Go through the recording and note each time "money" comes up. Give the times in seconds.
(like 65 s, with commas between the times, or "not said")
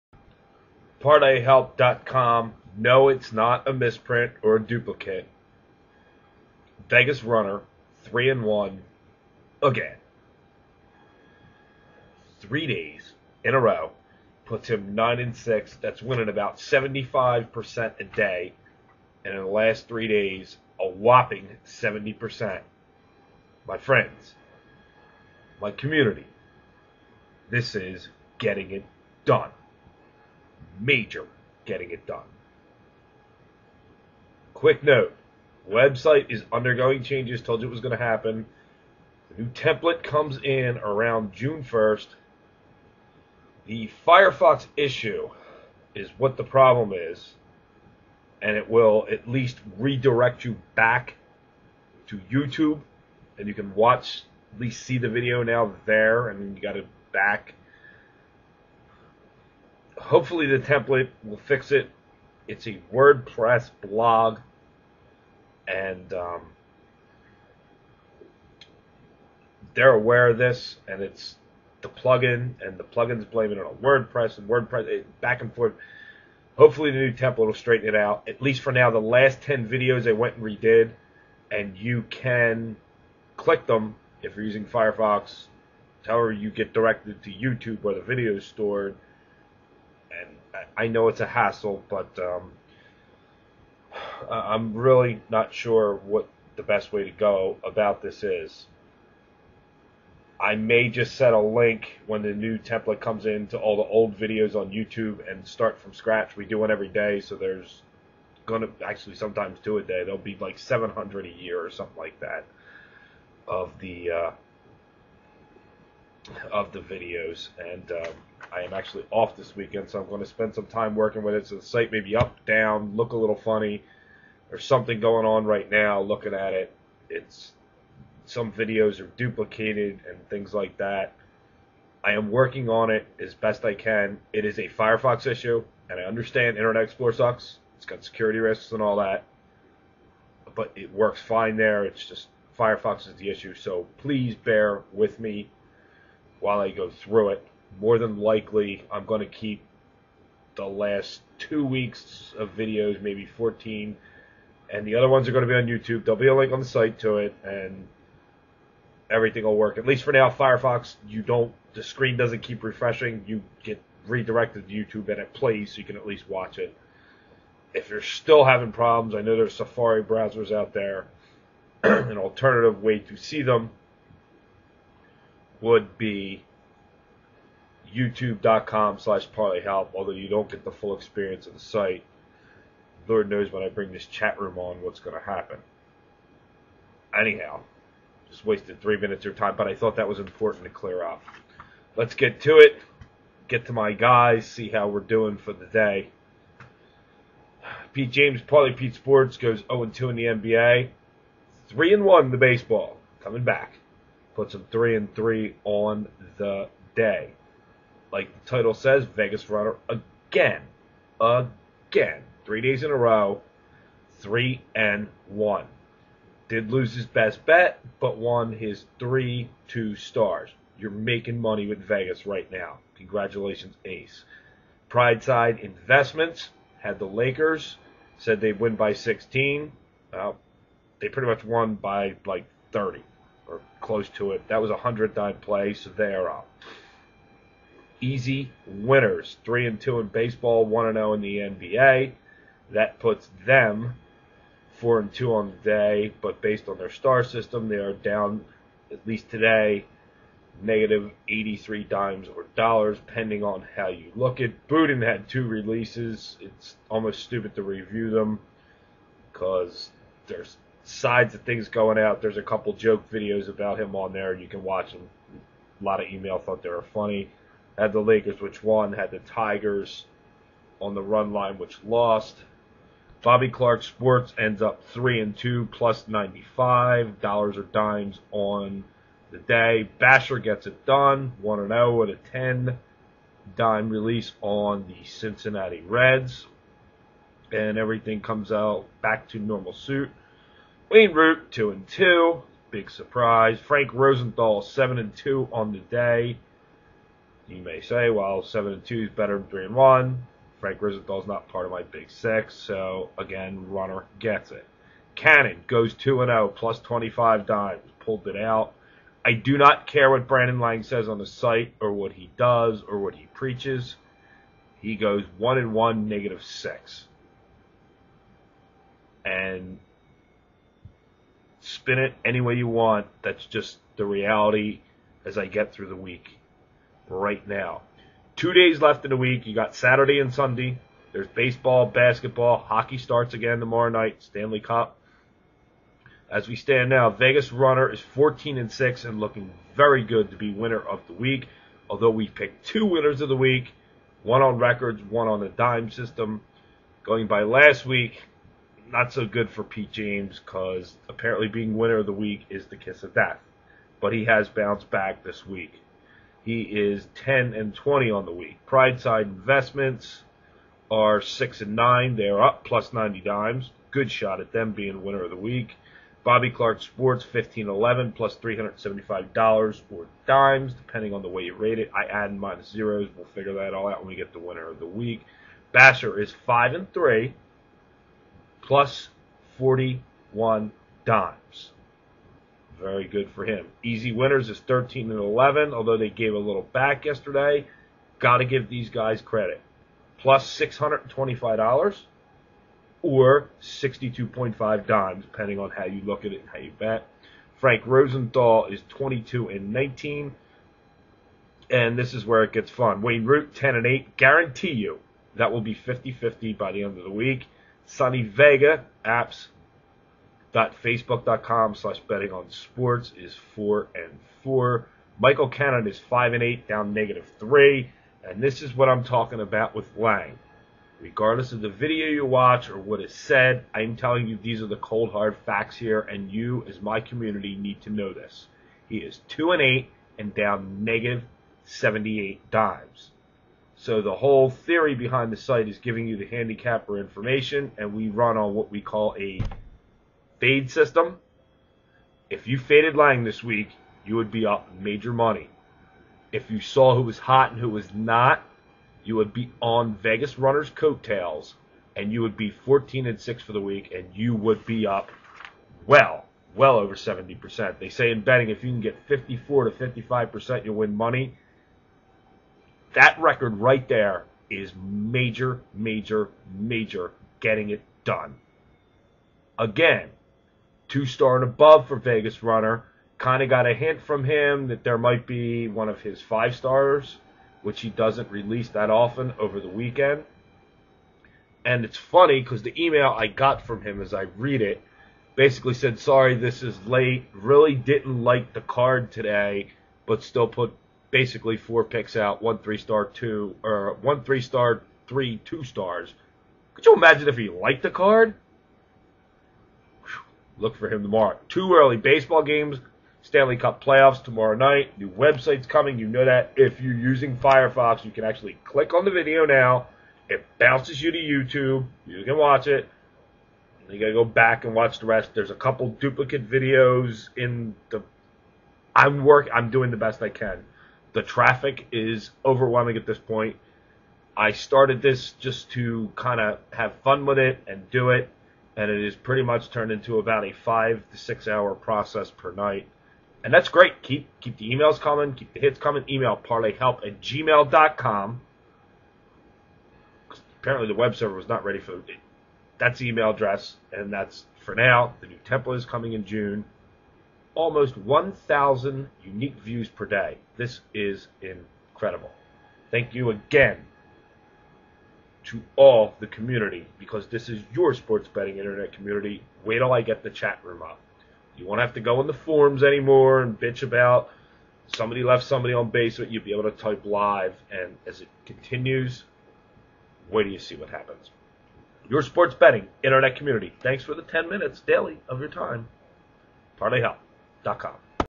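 221 s, 445 s, 460 s.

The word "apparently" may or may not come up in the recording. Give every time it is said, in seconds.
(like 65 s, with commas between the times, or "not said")
351 s, 540 s.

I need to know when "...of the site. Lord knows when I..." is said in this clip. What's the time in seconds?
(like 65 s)
181 s.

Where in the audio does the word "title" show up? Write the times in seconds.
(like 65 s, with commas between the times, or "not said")
208 s.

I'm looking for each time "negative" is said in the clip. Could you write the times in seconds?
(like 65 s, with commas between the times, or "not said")
250 s, 316 s, 416 s, 430 s.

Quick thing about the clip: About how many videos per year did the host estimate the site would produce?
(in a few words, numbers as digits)
700.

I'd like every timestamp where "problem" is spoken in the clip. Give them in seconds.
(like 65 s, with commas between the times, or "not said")
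46 s, 168 s.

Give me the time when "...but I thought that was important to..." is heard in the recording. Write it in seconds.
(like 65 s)
189 s.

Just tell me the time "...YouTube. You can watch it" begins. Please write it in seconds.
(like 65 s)
511 s.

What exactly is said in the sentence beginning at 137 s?
It's got security risks and all that, but it works fine there.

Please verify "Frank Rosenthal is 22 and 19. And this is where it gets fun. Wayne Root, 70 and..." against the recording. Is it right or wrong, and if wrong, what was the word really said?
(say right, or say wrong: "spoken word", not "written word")
wrong: "10", not "70".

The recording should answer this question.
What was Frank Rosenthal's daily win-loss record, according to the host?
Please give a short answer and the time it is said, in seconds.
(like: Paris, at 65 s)
7 and 2, at 294 s.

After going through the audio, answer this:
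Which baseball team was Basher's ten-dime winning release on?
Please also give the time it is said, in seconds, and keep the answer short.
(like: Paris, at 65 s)
Cincinnati Reds, at 285 s.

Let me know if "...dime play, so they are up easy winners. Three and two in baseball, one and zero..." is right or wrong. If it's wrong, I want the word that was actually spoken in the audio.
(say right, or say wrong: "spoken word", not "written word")
right.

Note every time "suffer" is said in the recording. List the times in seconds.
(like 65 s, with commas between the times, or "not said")
not said.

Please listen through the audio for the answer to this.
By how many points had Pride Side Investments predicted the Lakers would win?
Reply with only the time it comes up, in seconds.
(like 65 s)
228 s.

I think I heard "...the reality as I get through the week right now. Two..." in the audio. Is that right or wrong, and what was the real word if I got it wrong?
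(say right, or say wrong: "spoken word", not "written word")
right.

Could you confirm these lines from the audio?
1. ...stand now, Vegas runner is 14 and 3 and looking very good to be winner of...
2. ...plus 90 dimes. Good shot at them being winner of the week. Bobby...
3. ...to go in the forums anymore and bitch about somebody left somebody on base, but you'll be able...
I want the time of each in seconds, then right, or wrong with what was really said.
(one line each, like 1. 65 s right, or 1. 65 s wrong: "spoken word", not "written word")
1. 336 s wrong: "6", not "3"
2. 362 s right
3. 561 s right.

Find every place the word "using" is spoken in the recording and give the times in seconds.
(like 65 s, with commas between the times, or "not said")
84 s, 506 s.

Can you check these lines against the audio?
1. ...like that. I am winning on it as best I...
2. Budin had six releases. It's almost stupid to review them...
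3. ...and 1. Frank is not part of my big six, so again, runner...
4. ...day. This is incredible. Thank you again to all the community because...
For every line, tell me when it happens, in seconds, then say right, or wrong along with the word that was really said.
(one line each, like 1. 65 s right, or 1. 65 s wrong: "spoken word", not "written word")
1. 130 s wrong: "working", not "winning"
2. 254 s wrong: "two", not "six"
3. 299 s right
4. 550 s right.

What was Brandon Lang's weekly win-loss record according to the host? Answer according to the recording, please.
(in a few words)
2 and 8.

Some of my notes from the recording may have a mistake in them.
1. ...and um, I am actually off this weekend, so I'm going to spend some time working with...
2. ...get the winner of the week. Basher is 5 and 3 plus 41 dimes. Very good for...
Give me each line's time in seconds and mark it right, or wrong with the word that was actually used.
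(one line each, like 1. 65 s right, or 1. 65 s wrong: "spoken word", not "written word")
1. 117 s right
2. 374 s right.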